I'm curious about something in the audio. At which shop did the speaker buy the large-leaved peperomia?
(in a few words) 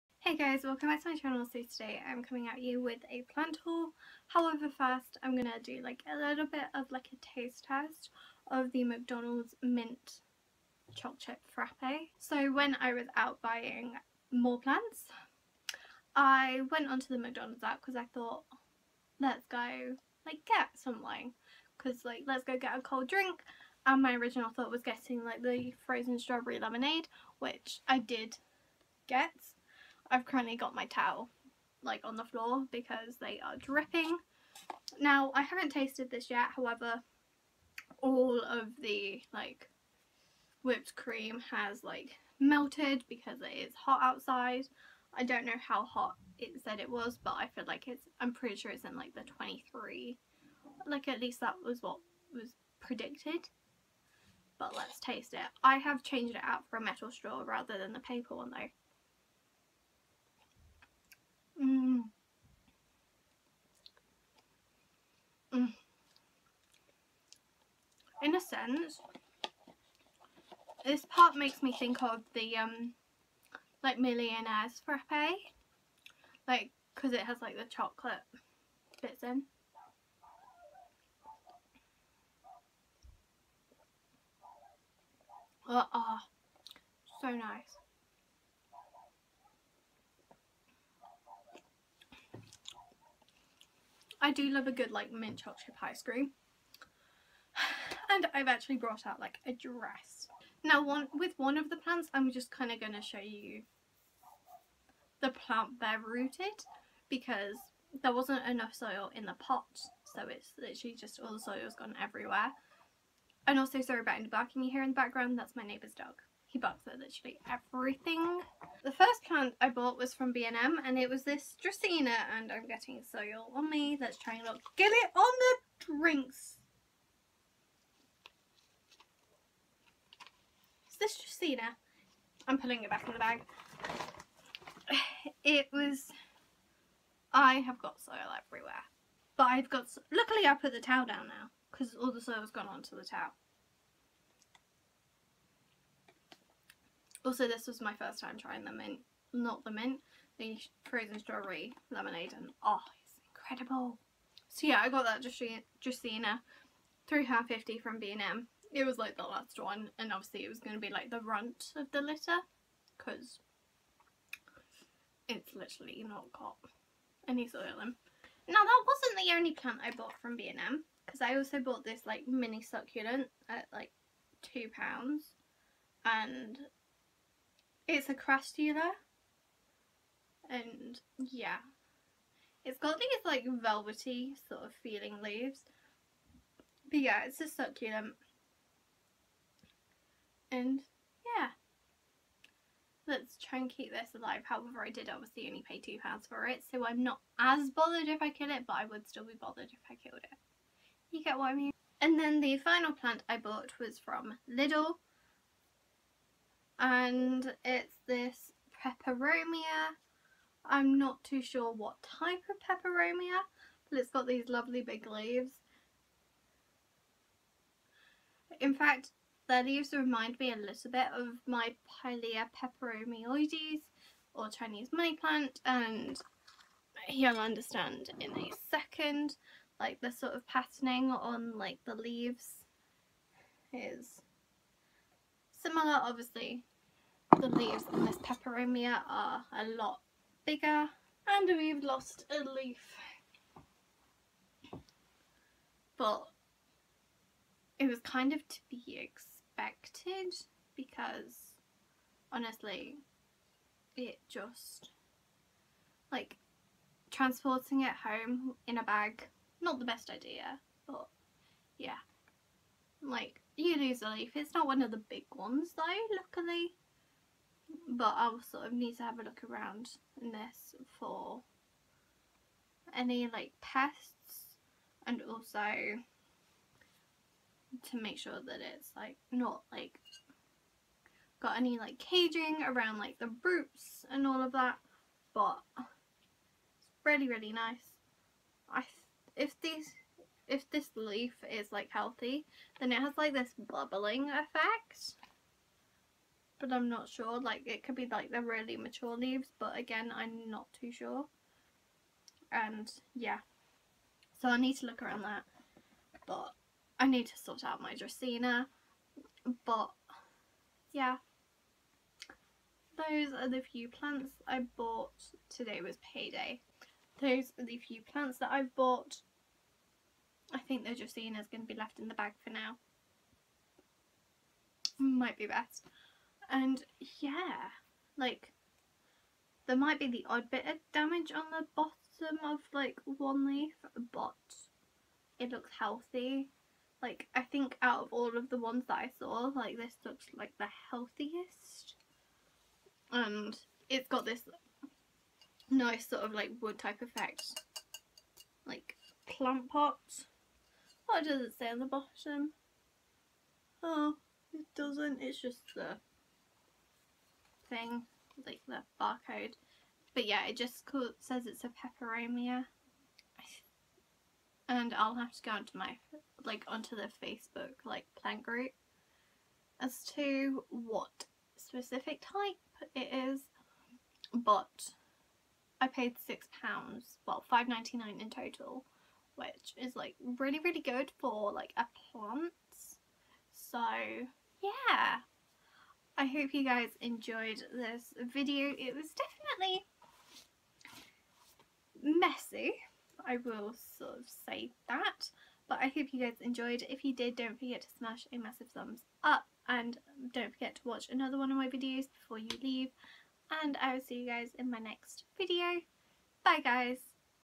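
Lidl.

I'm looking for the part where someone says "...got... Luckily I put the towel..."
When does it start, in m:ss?
2:19.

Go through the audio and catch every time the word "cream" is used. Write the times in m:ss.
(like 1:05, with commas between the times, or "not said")
0:40, 1:36.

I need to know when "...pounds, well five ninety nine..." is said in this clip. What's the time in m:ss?
6:16.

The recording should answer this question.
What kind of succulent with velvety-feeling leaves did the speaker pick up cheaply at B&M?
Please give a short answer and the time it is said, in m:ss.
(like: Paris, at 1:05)
Crassula, at 2:58.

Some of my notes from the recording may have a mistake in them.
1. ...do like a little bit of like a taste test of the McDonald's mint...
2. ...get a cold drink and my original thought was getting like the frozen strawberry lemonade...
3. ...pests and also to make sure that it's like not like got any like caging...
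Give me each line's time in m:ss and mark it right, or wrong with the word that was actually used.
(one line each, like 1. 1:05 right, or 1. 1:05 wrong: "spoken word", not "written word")
1. 0:05 right
2. 0:22 right
3. 4:33 right.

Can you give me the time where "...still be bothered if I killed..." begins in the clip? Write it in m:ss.
3:19.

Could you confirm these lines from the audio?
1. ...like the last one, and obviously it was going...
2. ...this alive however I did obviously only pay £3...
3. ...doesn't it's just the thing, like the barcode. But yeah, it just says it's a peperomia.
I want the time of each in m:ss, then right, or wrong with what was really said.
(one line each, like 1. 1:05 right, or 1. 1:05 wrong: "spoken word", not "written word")
1. 2:38 right
2. 3:13 wrong: "2", not "3"
3. 5:54 right.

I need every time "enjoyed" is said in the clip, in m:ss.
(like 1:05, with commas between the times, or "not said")
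6:27, 6:36.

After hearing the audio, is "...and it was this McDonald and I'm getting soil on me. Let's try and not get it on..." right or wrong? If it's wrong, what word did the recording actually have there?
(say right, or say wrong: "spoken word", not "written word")
wrong: "Dracaena", not "McDonald".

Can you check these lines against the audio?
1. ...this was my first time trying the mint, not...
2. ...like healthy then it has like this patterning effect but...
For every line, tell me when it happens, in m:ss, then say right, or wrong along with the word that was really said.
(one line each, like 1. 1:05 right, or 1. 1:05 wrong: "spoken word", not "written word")
1. 2:27 right
2. 4:51 wrong: "bubbling", not "patterning".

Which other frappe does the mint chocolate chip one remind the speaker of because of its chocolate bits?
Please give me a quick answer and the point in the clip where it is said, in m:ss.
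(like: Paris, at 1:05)
Millionaires frappe, at 1:13.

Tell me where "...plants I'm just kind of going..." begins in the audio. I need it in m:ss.
1:41.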